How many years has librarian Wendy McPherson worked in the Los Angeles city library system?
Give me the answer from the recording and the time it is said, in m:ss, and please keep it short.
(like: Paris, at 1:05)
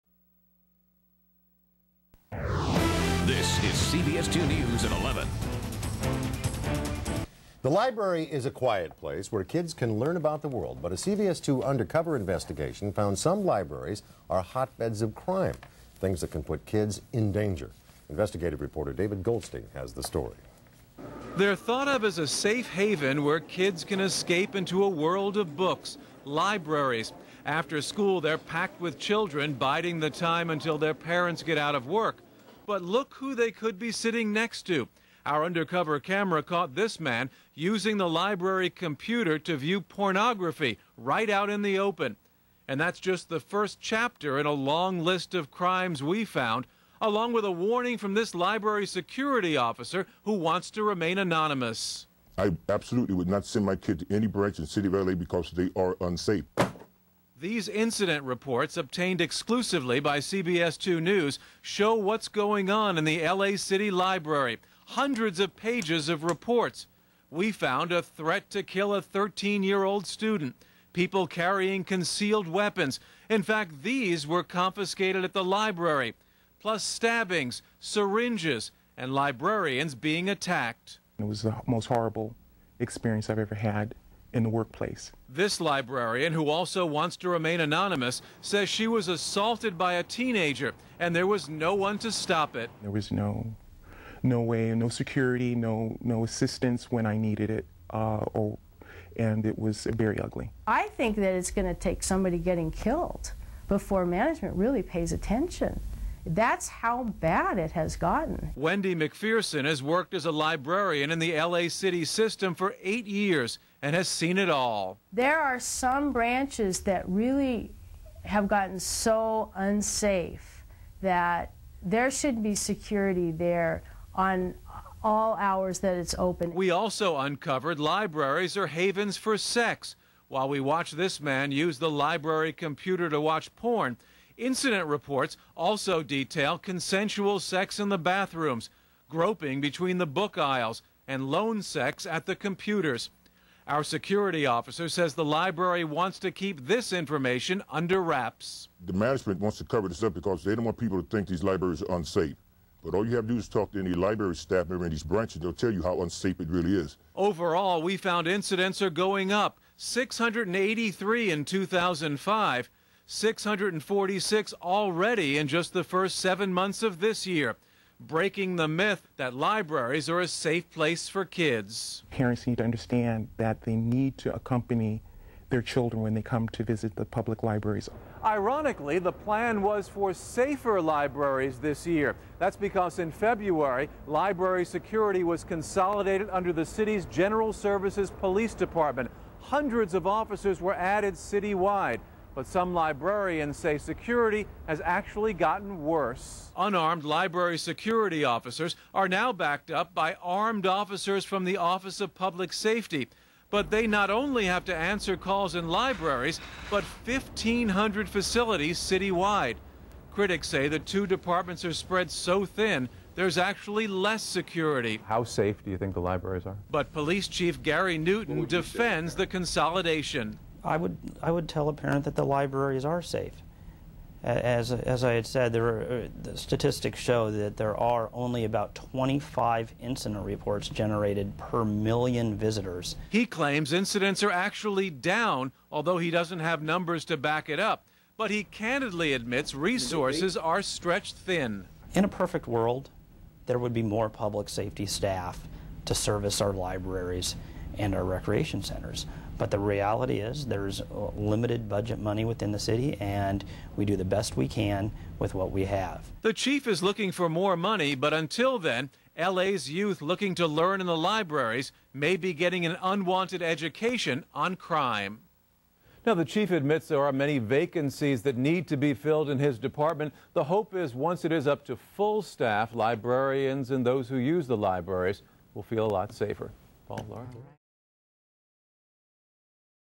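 8 years, at 1:52.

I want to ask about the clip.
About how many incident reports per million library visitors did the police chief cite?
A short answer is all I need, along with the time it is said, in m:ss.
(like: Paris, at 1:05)
25, at 3:48.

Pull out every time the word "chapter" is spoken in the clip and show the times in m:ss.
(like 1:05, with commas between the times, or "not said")
0:43.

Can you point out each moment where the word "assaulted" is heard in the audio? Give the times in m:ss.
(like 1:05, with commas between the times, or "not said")
1:29.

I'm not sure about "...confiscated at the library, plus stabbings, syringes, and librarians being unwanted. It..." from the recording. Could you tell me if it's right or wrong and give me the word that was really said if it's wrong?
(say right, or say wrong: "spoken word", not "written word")
wrong: "attacked", not "unwanted".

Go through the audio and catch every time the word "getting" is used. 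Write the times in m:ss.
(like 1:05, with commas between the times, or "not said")
1:42, 4:22.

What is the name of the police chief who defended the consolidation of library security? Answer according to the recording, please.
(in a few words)
Gary Newton.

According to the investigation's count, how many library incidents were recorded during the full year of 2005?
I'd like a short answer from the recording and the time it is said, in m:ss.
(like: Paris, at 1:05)
683, at 2:39.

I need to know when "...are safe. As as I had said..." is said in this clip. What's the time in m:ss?
3:42.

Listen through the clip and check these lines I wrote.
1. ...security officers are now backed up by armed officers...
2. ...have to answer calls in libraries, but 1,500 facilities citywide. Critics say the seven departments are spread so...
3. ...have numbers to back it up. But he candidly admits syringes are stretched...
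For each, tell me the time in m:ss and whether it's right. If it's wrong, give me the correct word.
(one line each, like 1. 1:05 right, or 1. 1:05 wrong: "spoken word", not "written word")
1. 3:17 right
2. 3:24 wrong: "two", not "seven"
3. 3:56 wrong: "resources", not "syringes".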